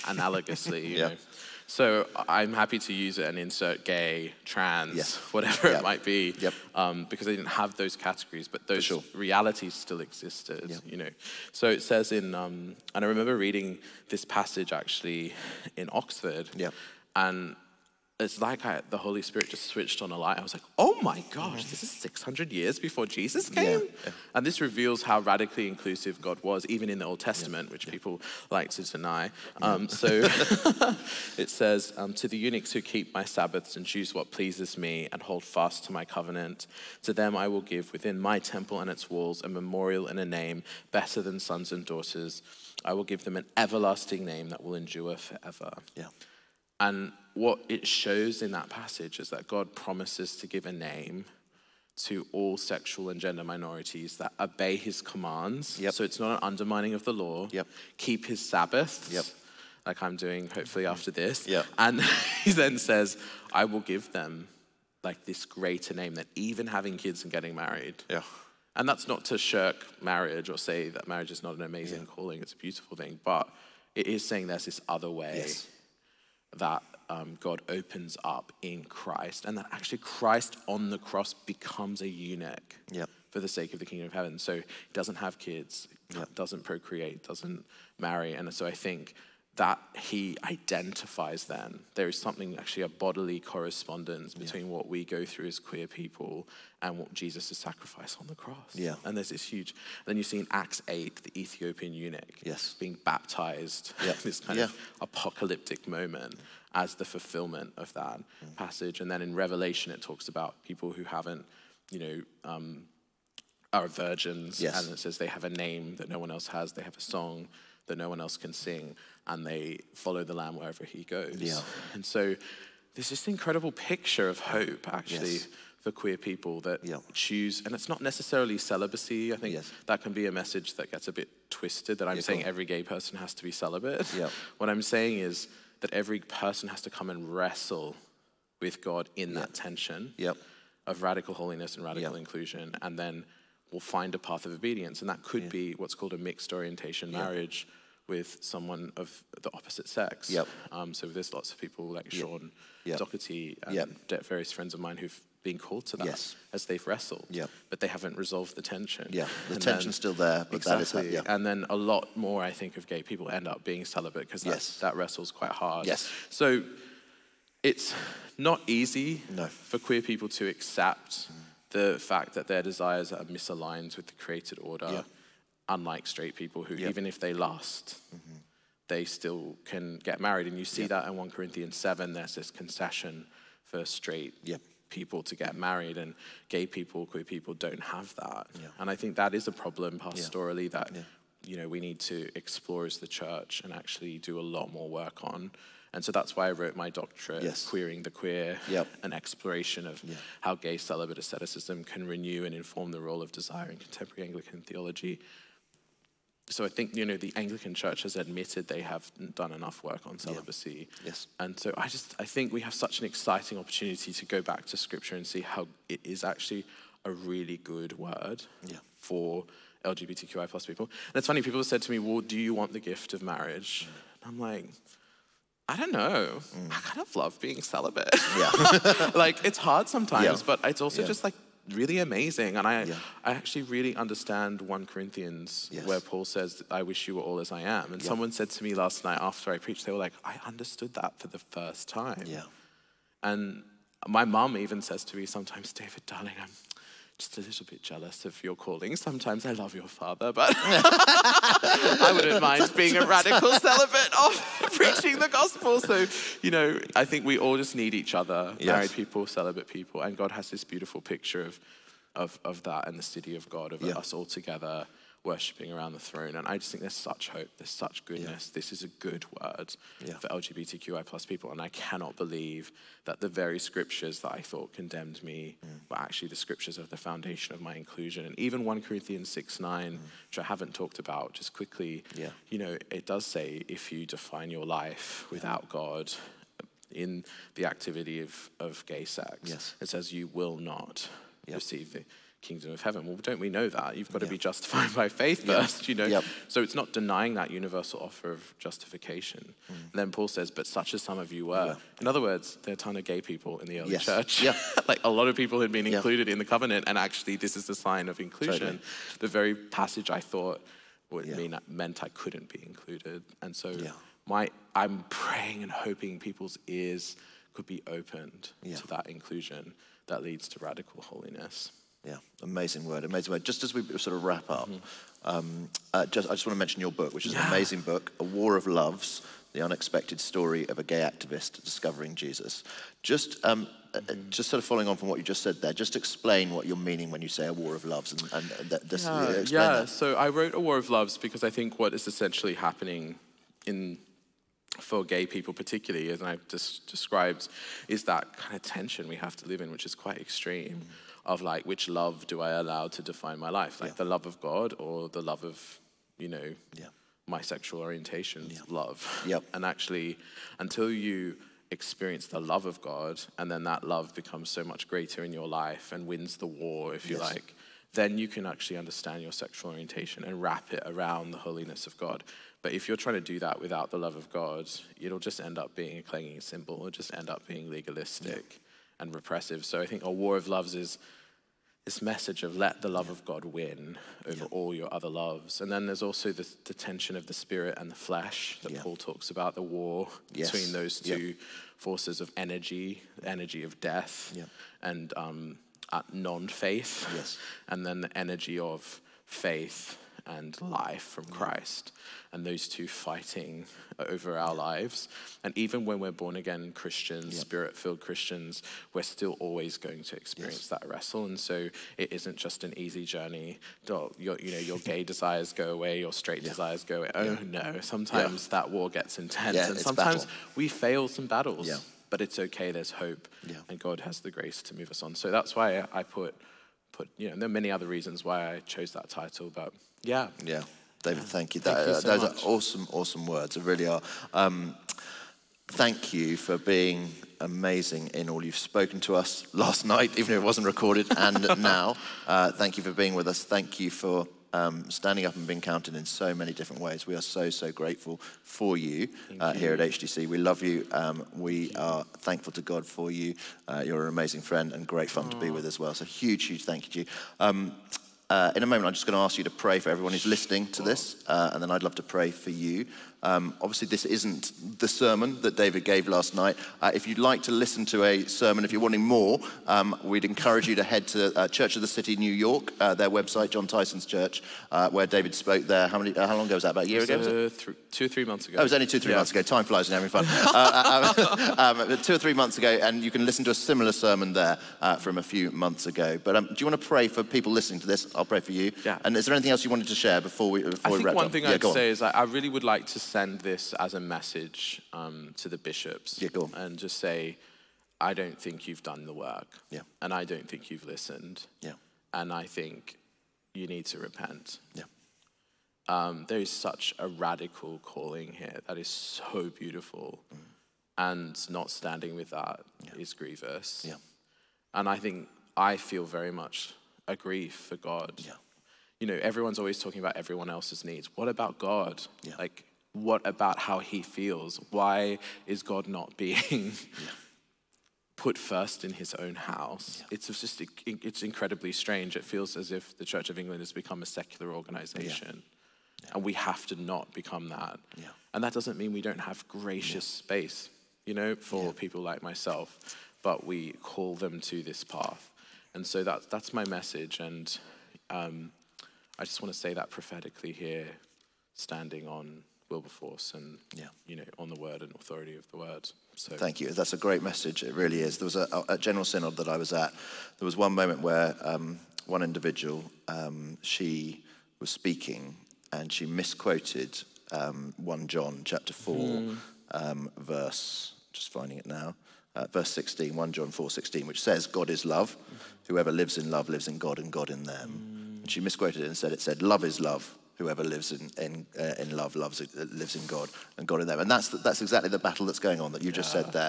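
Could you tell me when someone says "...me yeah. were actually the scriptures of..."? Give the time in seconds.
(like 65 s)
275 s.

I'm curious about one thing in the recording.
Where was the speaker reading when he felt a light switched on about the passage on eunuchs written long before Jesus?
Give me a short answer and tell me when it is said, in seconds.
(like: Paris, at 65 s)
Oxford, at 15 s.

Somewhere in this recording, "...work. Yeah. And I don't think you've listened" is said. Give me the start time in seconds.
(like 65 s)
499 s.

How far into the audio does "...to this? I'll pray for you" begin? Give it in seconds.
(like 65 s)
487 s.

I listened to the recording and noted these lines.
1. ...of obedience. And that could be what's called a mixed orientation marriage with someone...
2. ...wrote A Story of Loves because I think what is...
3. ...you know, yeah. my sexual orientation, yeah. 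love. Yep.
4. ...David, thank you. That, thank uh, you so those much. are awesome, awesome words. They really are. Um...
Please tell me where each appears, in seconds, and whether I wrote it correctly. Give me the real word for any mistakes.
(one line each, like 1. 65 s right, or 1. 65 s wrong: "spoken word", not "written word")
1. 144 s right
2. 340 s wrong: "War", not "Story"
3. 356 s right
4. 431 s right.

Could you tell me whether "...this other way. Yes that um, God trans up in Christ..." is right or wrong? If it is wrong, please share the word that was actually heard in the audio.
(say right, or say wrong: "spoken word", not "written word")
wrong: "opens", not "trans".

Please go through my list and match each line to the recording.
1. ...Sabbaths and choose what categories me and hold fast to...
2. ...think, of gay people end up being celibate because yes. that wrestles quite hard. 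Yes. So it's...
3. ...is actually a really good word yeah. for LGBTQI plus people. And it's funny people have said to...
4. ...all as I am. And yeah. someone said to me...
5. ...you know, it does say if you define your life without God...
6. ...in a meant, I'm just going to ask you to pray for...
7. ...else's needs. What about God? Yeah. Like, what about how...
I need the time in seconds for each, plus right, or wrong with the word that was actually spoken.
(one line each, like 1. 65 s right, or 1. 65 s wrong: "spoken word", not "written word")
1. 33 s wrong: "pleases", not "categories"
2. 162 s right
3. 216 s right
4. 237 s right
5. 282 s right
6. 458 s wrong: "moment", not "meant"
7. 520 s right.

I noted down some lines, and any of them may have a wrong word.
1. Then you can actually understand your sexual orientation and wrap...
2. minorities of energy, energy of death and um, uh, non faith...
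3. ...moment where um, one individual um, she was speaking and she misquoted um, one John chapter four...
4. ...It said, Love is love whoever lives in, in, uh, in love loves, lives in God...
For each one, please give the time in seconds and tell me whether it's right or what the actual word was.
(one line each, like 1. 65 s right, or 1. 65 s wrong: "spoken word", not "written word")
1. 367 s right
2. 391 s wrong: "forces", not "minorities"
3. 560 s right
4. 579 s right.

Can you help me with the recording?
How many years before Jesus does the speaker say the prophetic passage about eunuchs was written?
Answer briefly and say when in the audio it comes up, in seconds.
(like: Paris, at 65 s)
600, at 21 s.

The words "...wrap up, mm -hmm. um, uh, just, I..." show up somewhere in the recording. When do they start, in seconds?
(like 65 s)
324 s.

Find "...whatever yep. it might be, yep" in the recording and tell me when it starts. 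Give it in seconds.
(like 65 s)
5 s.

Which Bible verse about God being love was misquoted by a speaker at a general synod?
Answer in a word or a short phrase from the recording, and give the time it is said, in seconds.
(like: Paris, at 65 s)
1 John 4:16, at 573 s.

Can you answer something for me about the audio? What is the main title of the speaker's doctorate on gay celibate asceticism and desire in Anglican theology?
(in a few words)
Queering the Queer.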